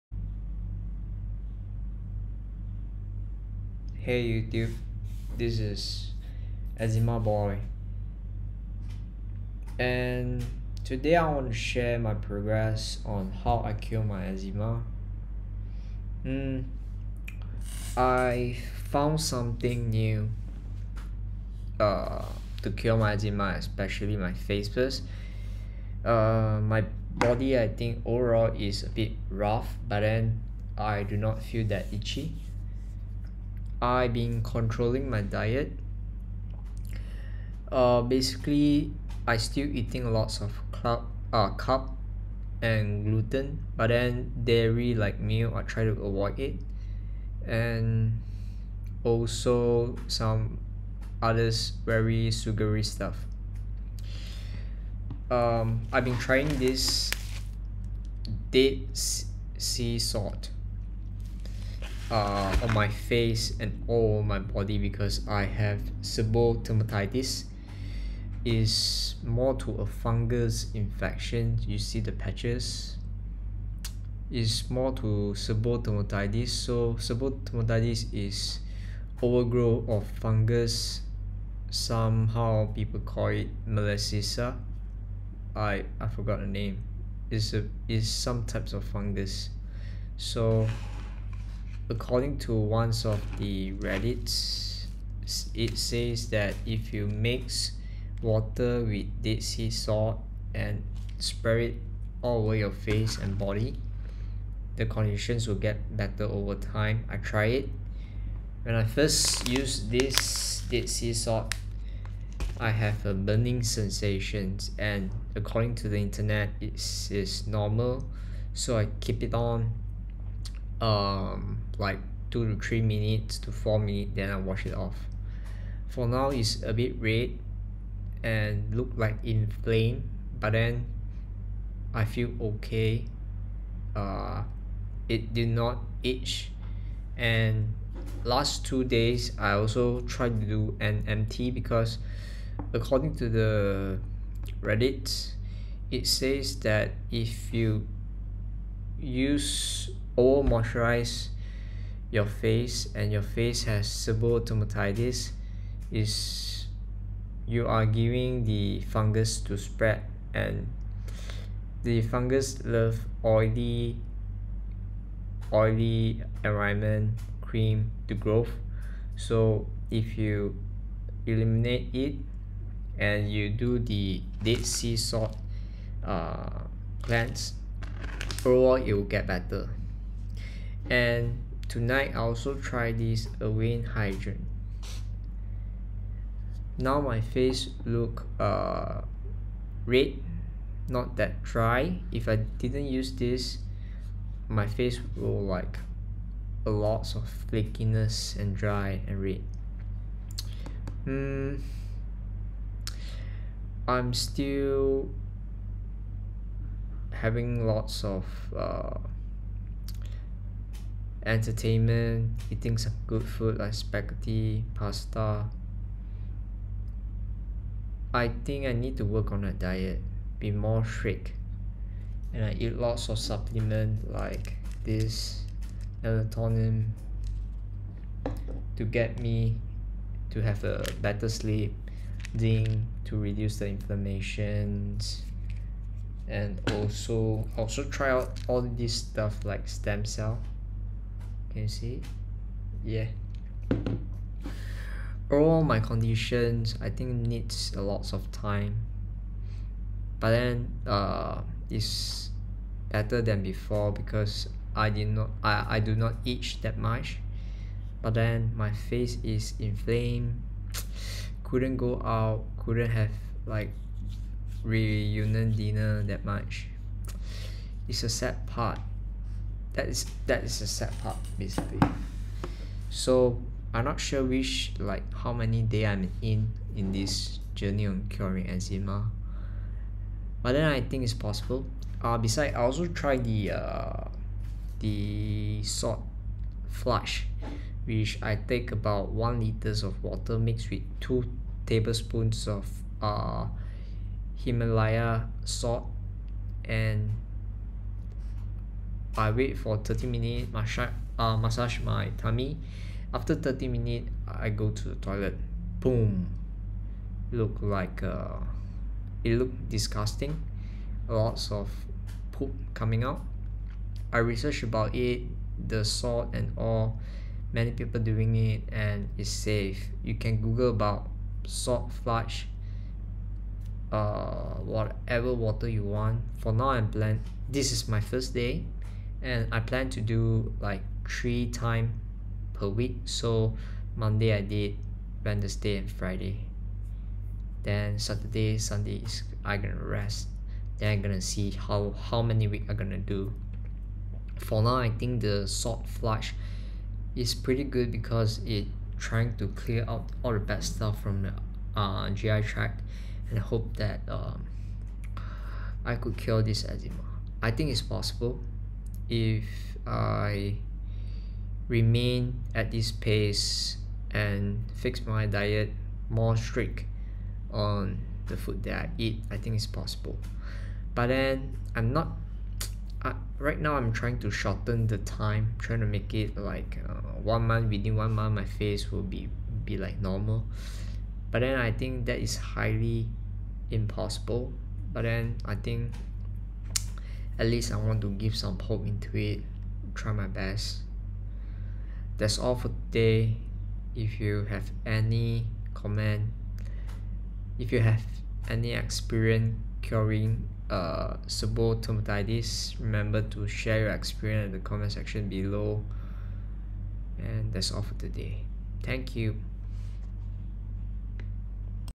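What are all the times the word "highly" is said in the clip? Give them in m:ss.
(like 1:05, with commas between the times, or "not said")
6:22.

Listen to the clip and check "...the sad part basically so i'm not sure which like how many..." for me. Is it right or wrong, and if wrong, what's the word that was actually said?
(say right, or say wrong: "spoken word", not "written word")
right.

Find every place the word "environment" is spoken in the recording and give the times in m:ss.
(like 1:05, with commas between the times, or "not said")
2:46.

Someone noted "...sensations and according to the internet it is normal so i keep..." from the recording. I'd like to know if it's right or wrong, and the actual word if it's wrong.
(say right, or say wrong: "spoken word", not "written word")
right.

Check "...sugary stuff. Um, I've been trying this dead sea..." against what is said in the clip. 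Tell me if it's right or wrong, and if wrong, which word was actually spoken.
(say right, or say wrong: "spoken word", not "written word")
right.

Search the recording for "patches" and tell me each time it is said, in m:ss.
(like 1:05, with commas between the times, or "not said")
1:12.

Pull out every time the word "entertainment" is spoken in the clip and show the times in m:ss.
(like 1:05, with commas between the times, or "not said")
3:31.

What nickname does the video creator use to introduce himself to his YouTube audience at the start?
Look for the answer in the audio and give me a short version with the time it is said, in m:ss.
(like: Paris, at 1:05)
Eczema Boy, at 0:06.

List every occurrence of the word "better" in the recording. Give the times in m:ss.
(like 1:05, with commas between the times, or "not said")
1:45, 2:59, 3:51, 4:12.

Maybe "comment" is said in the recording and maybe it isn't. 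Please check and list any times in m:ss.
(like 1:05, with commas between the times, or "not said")
6:35, 6:44.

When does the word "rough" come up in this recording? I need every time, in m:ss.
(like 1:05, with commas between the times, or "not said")
0:29.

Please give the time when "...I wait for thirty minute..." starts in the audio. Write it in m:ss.
4:59.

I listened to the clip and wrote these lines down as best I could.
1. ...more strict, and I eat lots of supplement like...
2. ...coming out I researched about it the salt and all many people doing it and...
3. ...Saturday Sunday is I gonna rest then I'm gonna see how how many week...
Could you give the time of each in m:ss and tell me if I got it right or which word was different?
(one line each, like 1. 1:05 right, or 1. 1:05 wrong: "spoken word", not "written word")
1. 3:40 right
2. 5:12 right
3. 5:37 right.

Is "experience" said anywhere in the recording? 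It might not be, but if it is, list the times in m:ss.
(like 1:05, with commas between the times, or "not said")
6:38, 6:43.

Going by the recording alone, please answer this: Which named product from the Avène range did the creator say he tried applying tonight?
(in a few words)
Avène Hydrance.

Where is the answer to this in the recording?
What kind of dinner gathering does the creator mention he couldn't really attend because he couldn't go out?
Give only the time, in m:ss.
4:24.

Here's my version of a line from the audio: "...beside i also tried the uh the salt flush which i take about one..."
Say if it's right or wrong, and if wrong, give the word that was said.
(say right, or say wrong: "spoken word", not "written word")
right.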